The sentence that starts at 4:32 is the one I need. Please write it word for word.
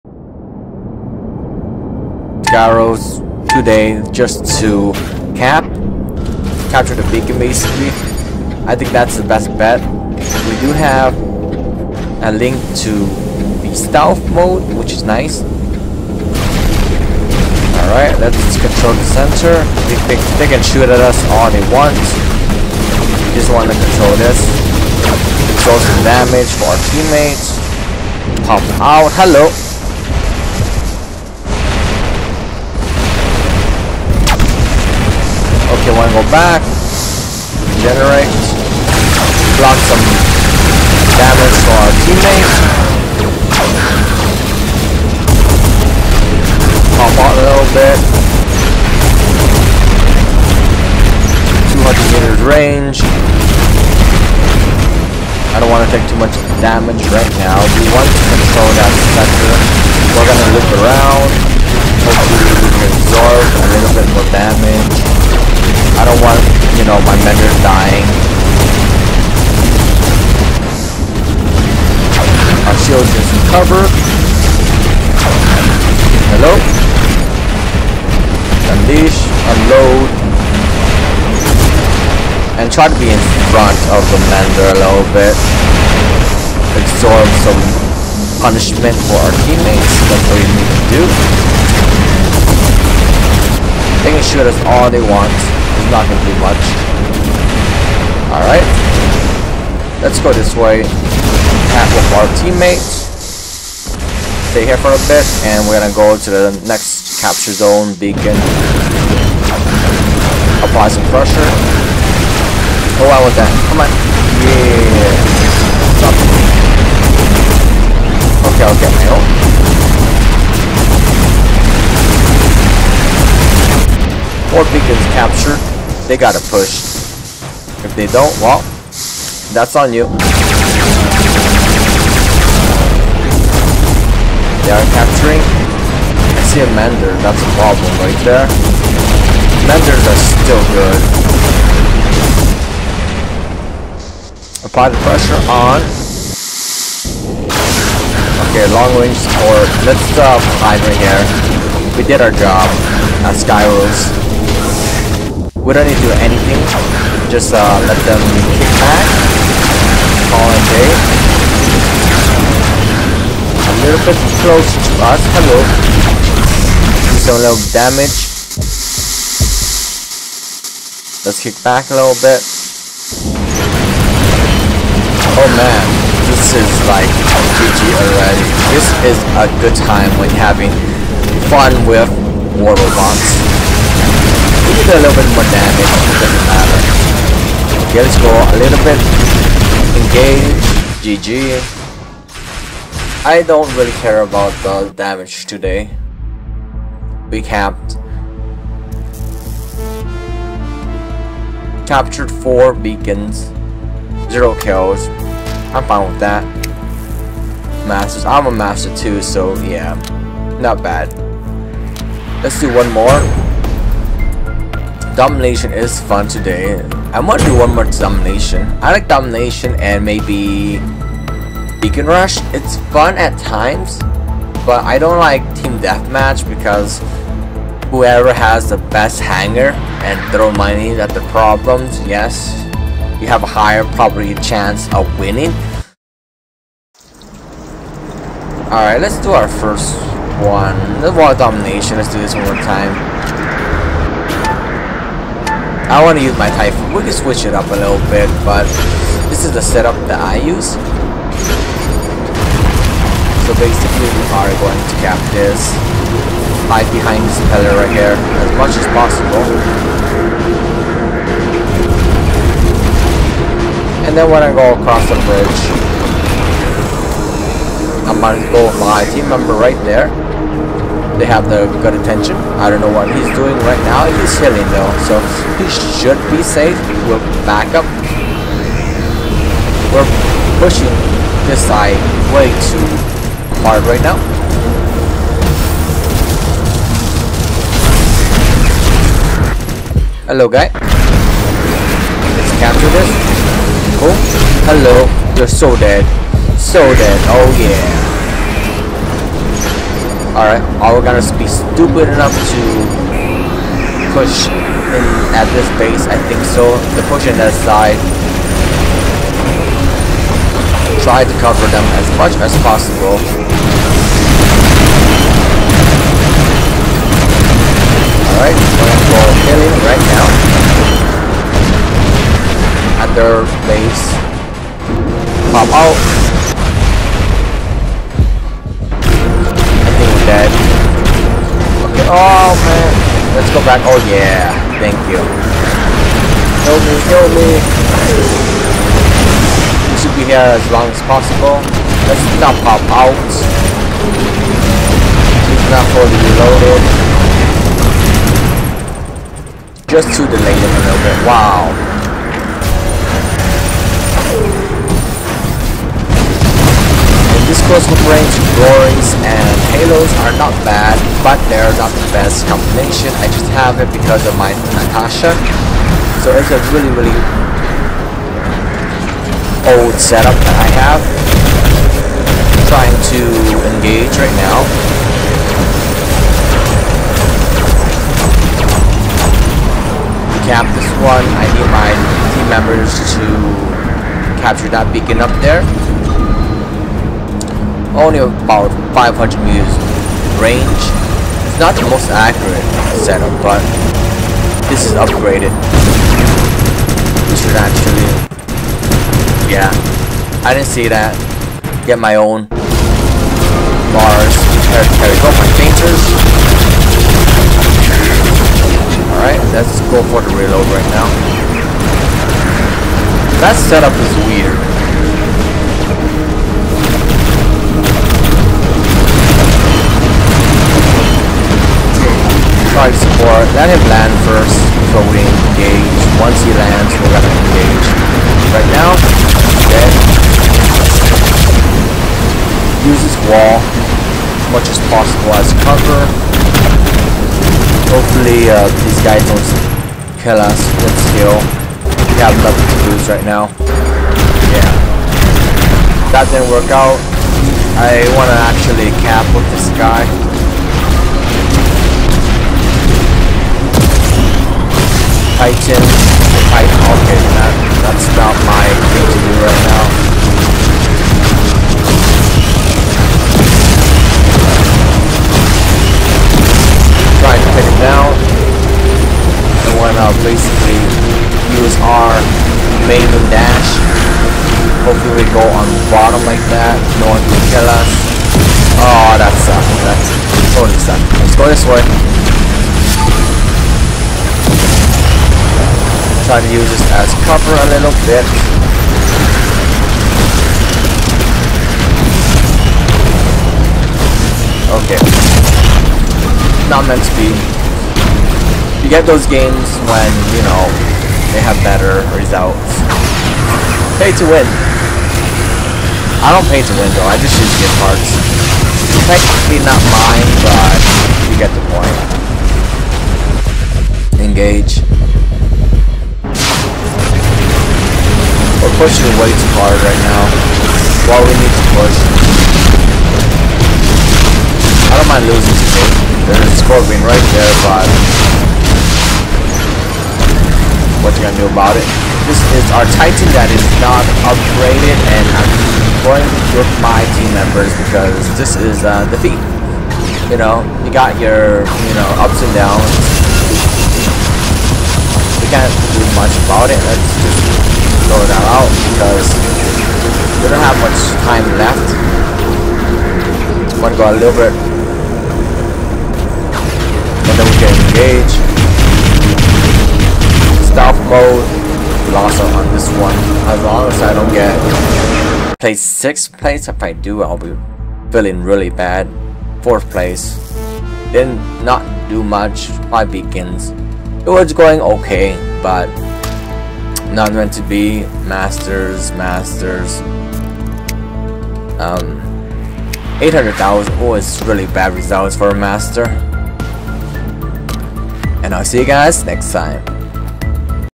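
I don't know what he's doing right now.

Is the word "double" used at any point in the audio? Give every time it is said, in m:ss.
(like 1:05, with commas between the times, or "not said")
not said.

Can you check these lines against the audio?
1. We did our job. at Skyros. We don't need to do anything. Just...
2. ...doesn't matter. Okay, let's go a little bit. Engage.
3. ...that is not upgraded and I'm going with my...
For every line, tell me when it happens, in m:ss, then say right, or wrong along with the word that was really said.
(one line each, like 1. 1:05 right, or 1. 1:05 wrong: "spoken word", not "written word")
1. 2:31 right
2. 3:06 right
3. 8:53 right.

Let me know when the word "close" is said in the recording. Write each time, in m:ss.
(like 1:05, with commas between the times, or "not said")
2:44, 5:57.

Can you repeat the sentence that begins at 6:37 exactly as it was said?
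This should actually, yeah, I didn't see that.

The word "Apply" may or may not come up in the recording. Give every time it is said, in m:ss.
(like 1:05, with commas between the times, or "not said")
1:50, 2:24.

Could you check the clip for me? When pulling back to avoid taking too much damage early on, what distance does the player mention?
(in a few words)
200 meters.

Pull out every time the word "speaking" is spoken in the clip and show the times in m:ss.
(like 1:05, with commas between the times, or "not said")
not said.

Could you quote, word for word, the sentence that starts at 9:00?
You know, you got your, you know, ups and downs.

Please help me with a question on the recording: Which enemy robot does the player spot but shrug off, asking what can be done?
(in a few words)
Scorpion.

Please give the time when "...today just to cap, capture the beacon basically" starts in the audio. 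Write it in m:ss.
0:03.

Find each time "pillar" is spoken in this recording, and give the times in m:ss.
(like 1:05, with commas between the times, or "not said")
4:17.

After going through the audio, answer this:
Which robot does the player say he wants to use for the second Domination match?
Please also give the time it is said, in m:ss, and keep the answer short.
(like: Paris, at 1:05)
Typhoon, at 4:06.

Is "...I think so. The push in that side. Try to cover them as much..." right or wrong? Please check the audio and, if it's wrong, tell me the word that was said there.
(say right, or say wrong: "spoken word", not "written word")
right.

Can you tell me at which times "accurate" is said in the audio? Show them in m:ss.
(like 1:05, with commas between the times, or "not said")
6:32.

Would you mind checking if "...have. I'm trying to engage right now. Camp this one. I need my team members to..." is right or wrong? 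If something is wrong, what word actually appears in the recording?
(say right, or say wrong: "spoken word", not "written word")
right.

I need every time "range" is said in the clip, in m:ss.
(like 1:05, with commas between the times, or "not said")
0:52, 2:28, 5:58, 6:30.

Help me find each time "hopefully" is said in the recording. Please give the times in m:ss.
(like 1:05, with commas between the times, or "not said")
1:02, 7:17, 7:54.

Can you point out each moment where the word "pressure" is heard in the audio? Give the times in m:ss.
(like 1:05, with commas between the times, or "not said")
1:51, 2:25.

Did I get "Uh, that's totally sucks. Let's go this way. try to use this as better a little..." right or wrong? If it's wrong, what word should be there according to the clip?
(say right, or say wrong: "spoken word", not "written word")
wrong: "cover", not "better".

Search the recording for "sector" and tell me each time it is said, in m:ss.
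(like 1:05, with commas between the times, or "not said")
0:59.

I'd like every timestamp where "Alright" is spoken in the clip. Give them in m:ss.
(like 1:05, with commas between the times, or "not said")
0:17, 1:38, 3:58, 5:00, 5:18, 6:49.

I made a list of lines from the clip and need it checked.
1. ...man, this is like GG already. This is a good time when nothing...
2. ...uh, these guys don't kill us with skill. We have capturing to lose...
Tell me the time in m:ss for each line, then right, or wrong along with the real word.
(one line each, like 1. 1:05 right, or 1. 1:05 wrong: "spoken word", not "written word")
1. 2:55 wrong: "having", not "nothing"
2. 7:18 wrong: "nothing", not "capturing".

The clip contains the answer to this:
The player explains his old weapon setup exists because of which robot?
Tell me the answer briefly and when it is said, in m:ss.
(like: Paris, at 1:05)
Natasha, at 6:04.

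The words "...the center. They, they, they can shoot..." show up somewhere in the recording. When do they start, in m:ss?
0:18.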